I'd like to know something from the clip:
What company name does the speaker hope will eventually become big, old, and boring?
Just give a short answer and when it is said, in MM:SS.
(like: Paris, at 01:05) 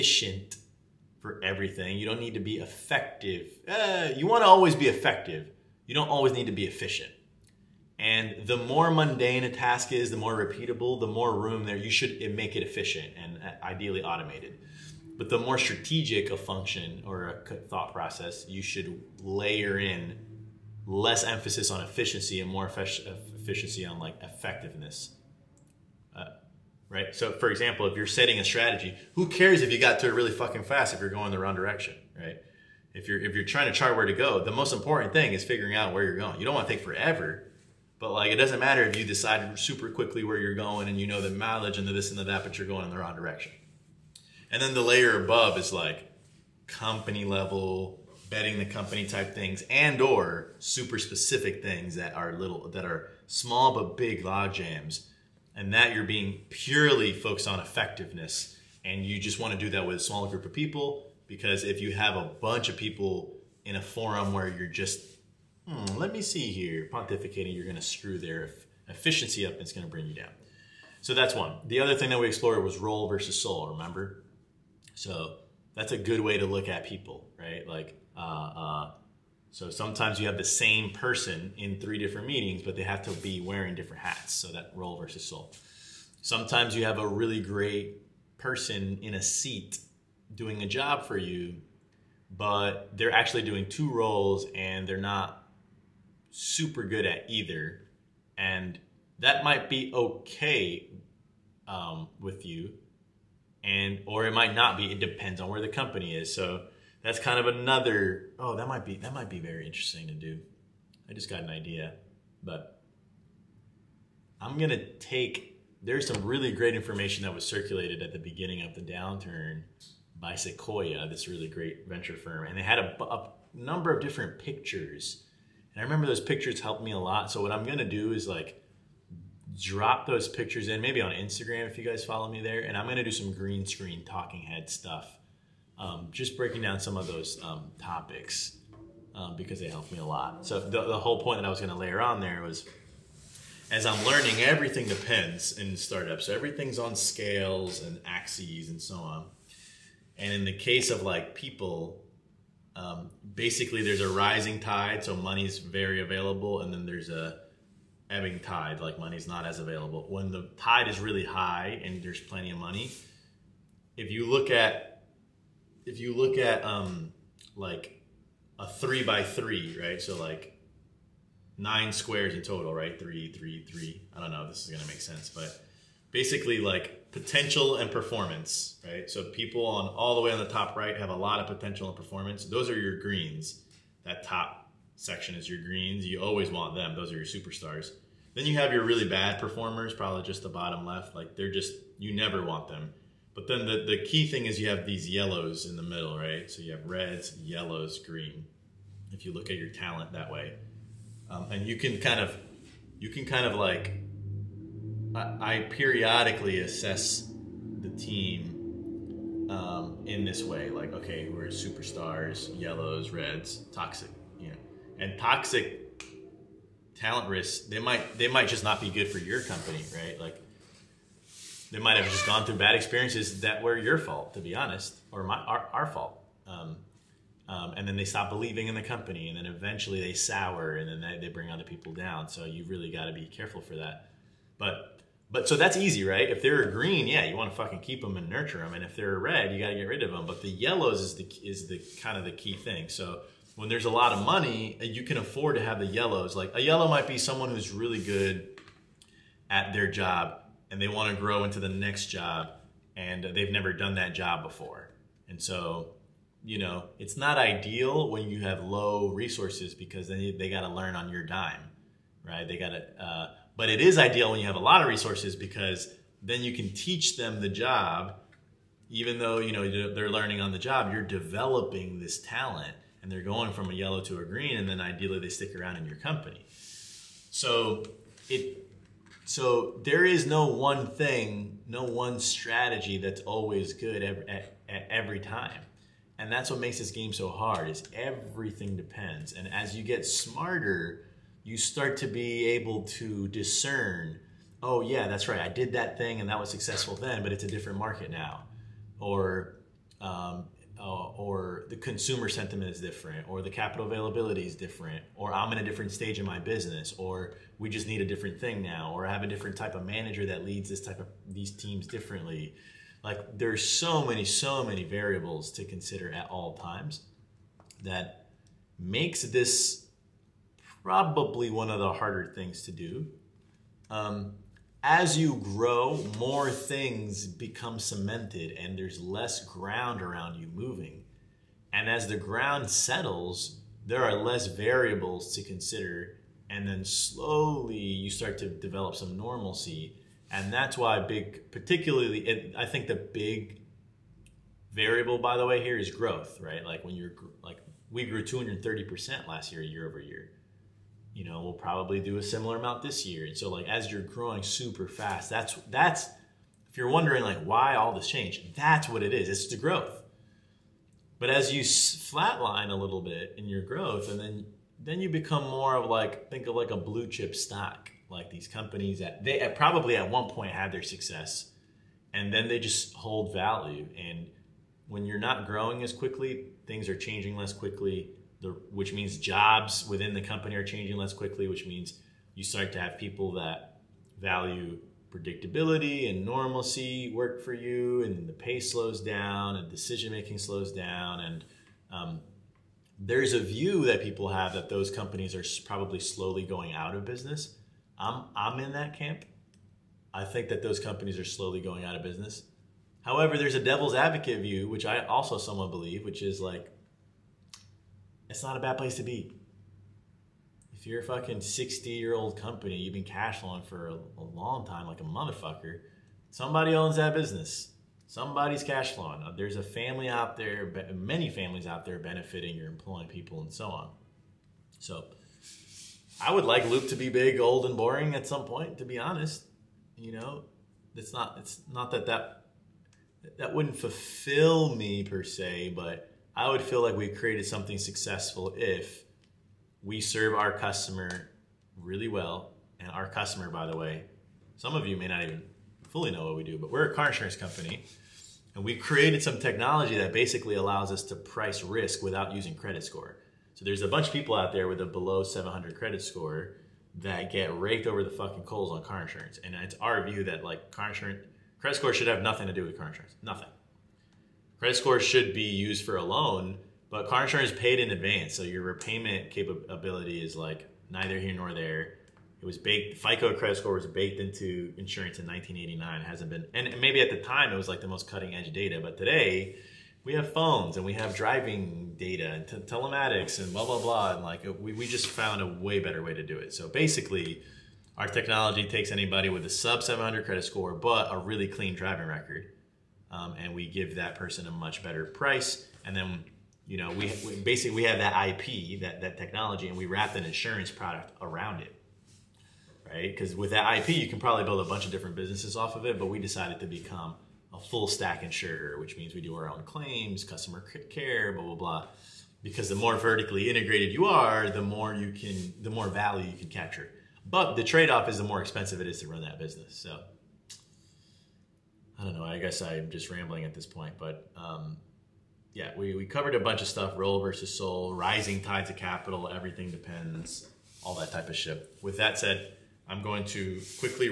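Loop, at 07:06.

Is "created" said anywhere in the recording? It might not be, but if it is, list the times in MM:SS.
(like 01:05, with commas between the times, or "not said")
07:17, 07:28.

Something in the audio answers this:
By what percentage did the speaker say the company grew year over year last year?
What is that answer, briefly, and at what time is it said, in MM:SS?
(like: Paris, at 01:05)
230%, at 05:48.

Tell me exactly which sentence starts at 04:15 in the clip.
And so, you know, it's not ideal when you have low resources because then they, got to learn on your dime, right?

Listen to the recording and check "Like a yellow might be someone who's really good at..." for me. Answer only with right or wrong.
right.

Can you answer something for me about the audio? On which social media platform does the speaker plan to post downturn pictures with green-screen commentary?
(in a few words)
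Instagram.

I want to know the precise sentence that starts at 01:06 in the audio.
Pontificating, you're going to screw their efficiency up and it's going to bring you down.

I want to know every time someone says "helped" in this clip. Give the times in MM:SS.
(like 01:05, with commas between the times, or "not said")
02:06, 02:19.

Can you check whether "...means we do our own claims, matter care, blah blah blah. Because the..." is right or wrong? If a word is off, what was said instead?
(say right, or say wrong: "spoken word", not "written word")
wrong: "customer", not "matter".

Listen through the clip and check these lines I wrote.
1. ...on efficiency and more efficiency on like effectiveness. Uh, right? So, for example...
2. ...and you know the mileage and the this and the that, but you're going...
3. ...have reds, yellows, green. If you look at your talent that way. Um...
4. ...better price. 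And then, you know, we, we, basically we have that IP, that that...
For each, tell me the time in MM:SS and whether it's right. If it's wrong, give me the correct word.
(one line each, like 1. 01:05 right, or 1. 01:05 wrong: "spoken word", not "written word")
1. 00:21 right
2. 00:40 right
3. 03:16 right
4. 08:14 right.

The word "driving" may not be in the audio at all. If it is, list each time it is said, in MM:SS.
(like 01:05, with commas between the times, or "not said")
08:01, 08:11.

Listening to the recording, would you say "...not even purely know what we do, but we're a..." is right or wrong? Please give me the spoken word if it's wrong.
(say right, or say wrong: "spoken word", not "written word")
wrong: "fully", not "purely".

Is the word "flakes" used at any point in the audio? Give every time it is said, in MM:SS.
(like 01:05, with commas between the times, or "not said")
not said.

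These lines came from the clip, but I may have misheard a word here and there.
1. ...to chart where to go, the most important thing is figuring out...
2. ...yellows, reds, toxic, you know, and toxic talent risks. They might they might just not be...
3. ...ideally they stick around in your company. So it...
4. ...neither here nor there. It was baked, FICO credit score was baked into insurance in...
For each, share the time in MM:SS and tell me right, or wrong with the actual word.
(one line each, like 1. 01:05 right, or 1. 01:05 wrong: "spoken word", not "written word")
1. 00:33 right
2. 03:32 right
3. 04:34 right
4. 07:50 right.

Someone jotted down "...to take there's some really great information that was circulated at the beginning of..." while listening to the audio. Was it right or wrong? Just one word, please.
right.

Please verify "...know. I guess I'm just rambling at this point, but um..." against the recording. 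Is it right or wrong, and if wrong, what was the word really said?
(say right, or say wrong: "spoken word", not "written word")
right.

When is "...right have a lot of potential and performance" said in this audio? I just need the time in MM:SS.
03:00.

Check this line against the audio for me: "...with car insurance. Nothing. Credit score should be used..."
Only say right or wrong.
right.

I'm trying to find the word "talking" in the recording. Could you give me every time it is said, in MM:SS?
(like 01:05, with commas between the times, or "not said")
02:14.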